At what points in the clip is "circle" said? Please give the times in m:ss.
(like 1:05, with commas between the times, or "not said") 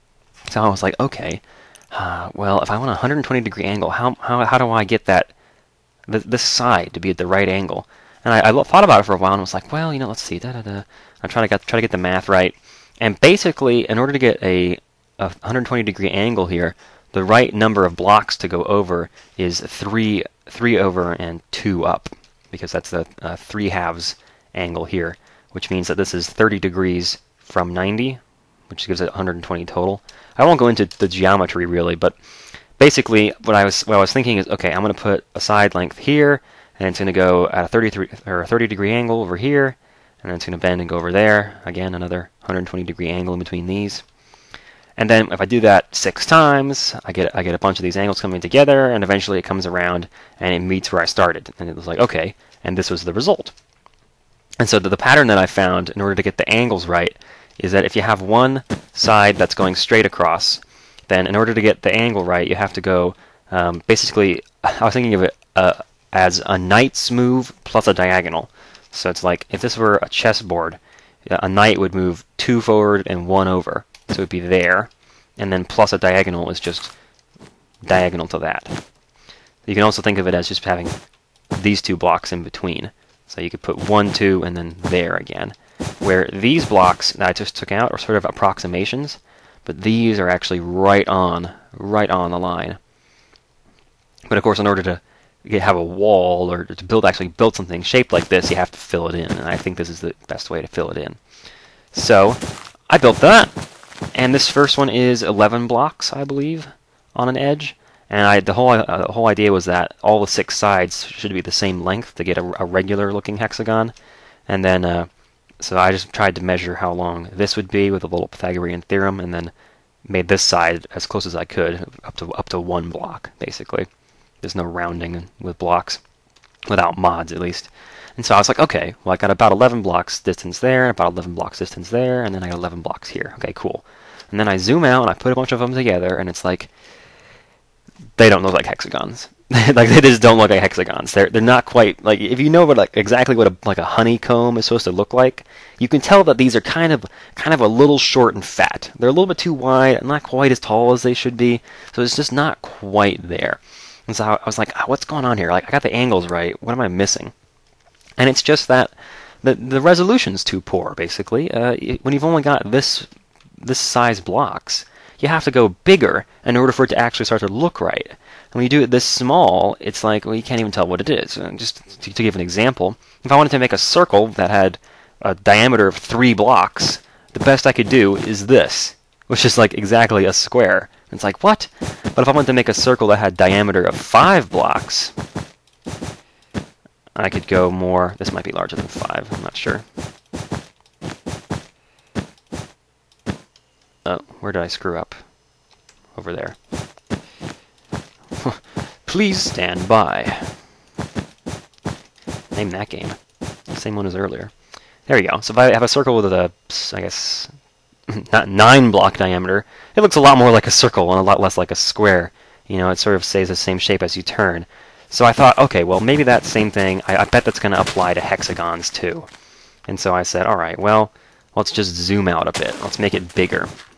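2:53, 3:02, 3:25, 3:30.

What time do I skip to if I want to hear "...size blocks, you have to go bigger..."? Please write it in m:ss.
2:43.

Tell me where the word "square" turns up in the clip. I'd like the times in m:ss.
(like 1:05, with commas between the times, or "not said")
3:00, 3:31.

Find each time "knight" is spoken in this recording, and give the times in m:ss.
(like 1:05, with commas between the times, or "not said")
1:06, 1:11.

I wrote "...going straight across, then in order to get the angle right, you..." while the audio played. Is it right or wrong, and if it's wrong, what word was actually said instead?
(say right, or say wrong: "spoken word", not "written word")
right.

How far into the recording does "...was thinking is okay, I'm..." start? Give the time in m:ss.
0:34.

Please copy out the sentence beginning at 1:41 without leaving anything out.
So I built that, and this first one is 11 blocks, I believe, on an edge.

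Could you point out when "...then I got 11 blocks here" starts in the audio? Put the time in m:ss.
2:12.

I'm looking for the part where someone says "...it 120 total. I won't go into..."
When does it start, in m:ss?
0:29.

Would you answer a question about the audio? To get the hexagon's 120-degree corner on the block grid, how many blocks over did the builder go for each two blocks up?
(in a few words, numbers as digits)
3.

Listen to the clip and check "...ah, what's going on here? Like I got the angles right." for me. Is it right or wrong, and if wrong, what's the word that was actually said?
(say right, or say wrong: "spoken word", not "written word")
right.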